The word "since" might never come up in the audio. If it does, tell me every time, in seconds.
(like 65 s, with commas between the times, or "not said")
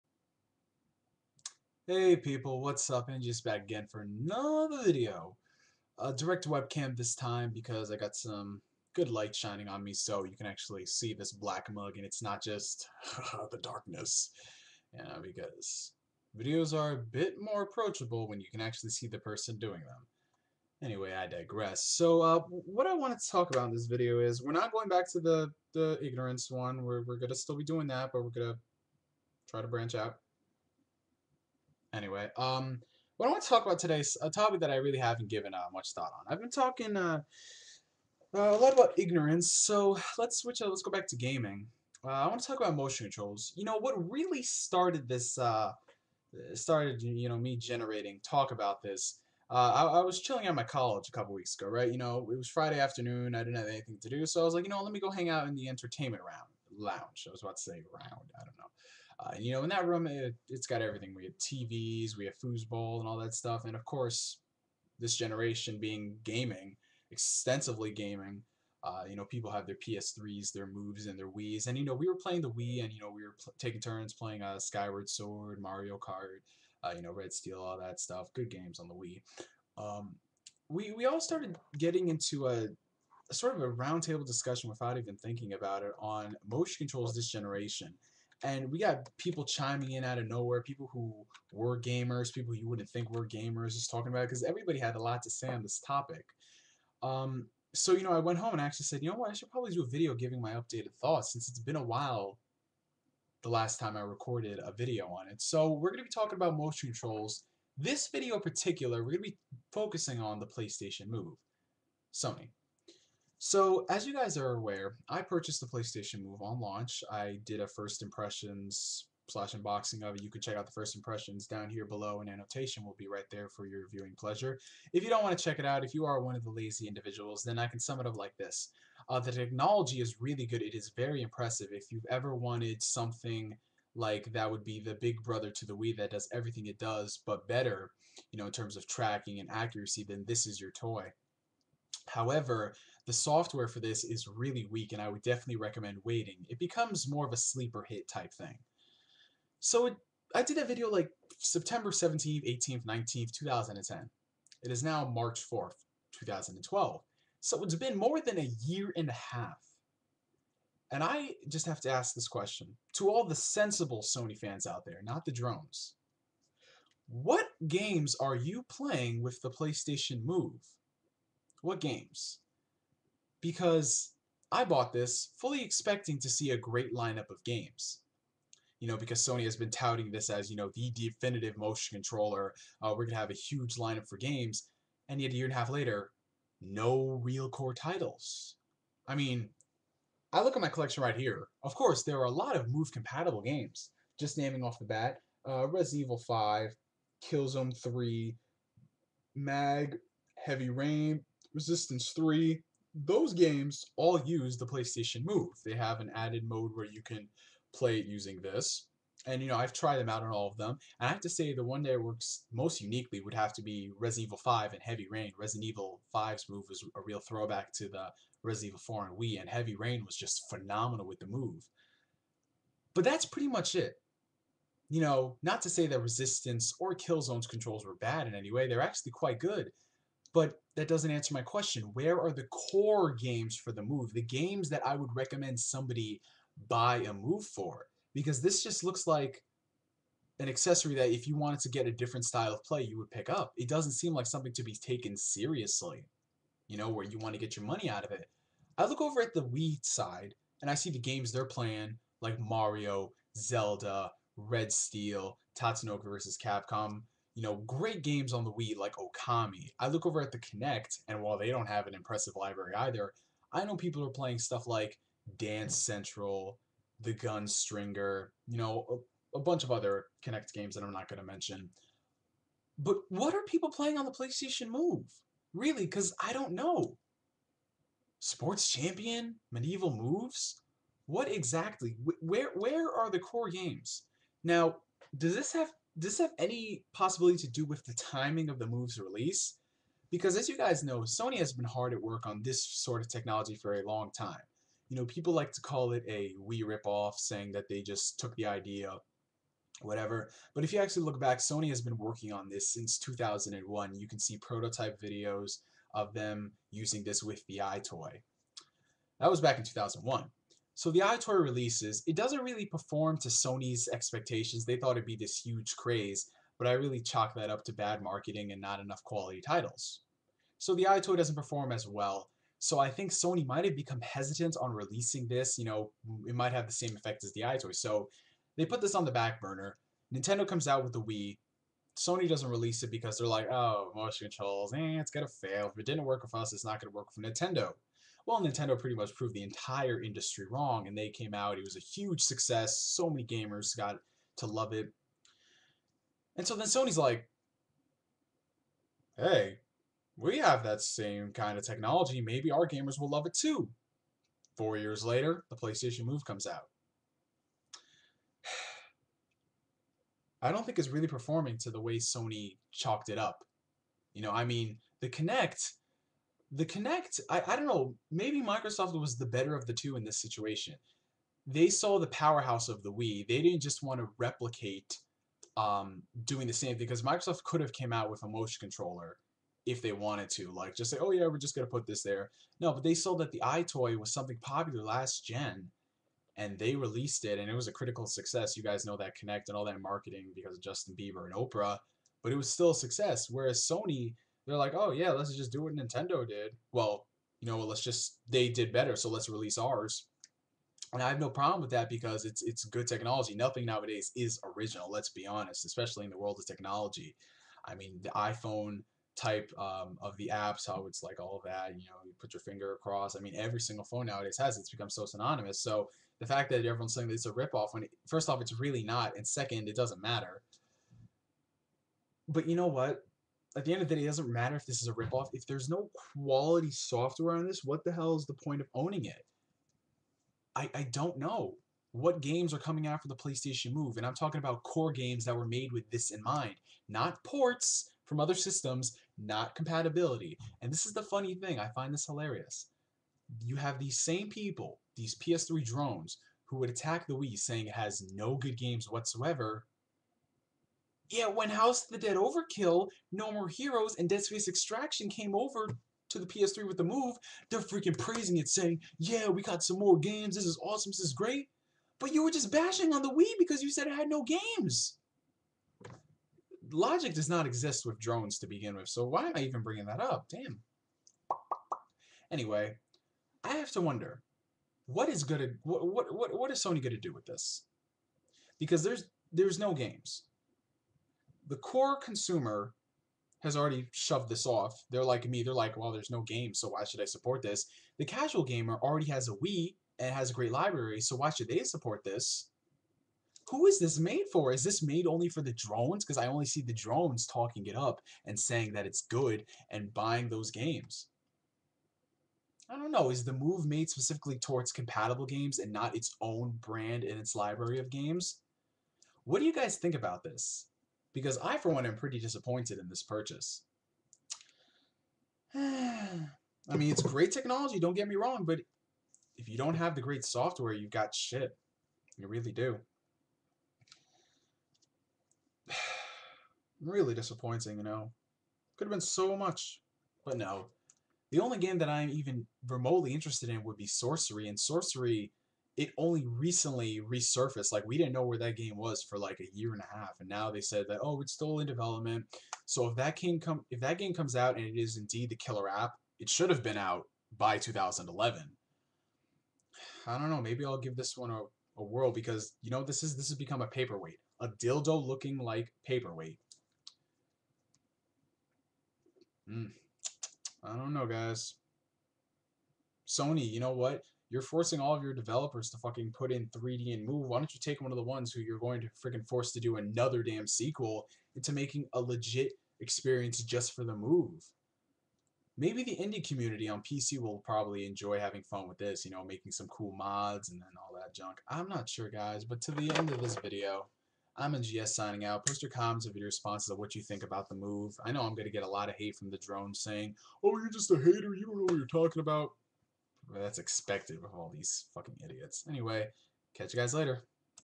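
101 s, 302 s.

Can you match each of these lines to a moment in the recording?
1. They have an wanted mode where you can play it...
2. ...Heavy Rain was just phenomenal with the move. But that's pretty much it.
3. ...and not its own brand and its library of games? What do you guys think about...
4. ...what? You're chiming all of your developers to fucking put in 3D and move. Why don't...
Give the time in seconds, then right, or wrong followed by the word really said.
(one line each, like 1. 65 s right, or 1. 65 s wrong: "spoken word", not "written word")
1. 205 s wrong: "added", not "wanted"
2. 219 s right
3. 505 s right
4. 563 s wrong: "forcing", not "chiming".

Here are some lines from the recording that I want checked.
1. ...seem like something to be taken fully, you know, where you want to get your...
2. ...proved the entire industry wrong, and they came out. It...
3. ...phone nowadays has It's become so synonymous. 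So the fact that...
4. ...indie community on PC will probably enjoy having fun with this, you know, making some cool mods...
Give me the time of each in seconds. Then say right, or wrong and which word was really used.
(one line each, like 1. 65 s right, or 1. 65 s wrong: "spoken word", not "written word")
1. 243 s wrong: "seriously", not "fully"
2. 339 s right
3. 413 s right
4. 575 s right.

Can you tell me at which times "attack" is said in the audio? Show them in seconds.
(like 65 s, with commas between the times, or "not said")
446 s.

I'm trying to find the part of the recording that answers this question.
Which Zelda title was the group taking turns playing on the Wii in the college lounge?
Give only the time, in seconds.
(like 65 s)
74 s.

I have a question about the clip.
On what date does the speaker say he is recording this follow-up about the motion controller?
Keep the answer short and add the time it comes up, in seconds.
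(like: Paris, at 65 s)
March 4th, 2012, at 155 s.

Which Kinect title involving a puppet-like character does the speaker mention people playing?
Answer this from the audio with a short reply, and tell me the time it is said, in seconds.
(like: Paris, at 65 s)
The Gunstringer, at 267 s.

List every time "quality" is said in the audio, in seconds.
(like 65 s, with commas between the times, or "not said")
319 s, 426 s.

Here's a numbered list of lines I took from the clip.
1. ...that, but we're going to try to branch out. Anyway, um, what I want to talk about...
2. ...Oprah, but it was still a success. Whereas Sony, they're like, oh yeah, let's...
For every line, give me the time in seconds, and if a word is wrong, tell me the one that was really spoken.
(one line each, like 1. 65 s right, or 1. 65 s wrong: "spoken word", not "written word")
1. 27 s right
2. 391 s right.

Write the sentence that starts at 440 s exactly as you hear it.
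And this is the funny thing, I find this hilarious.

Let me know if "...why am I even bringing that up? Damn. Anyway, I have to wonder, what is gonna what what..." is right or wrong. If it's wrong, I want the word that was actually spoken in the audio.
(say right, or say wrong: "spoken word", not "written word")
right.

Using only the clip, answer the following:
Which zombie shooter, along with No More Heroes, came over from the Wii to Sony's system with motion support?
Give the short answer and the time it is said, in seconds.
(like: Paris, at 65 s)
House of the Dead Overkill, at 451 s.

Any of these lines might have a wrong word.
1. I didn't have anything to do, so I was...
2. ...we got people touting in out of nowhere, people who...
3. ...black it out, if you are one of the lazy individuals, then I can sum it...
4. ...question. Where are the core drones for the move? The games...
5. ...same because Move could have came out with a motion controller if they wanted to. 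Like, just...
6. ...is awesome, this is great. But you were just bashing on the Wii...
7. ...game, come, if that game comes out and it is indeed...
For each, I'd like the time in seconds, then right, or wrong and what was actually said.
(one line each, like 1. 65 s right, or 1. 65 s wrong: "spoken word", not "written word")
1. 53 s right
2. 88 s wrong: "chiming", not "touting"
3. 125 s wrong: "check", not "black"
4. 231 s wrong: "games", not "drones"
5. 376 s wrong: "Microsoft", not "Move"
6. 460 s right
7. 543 s right.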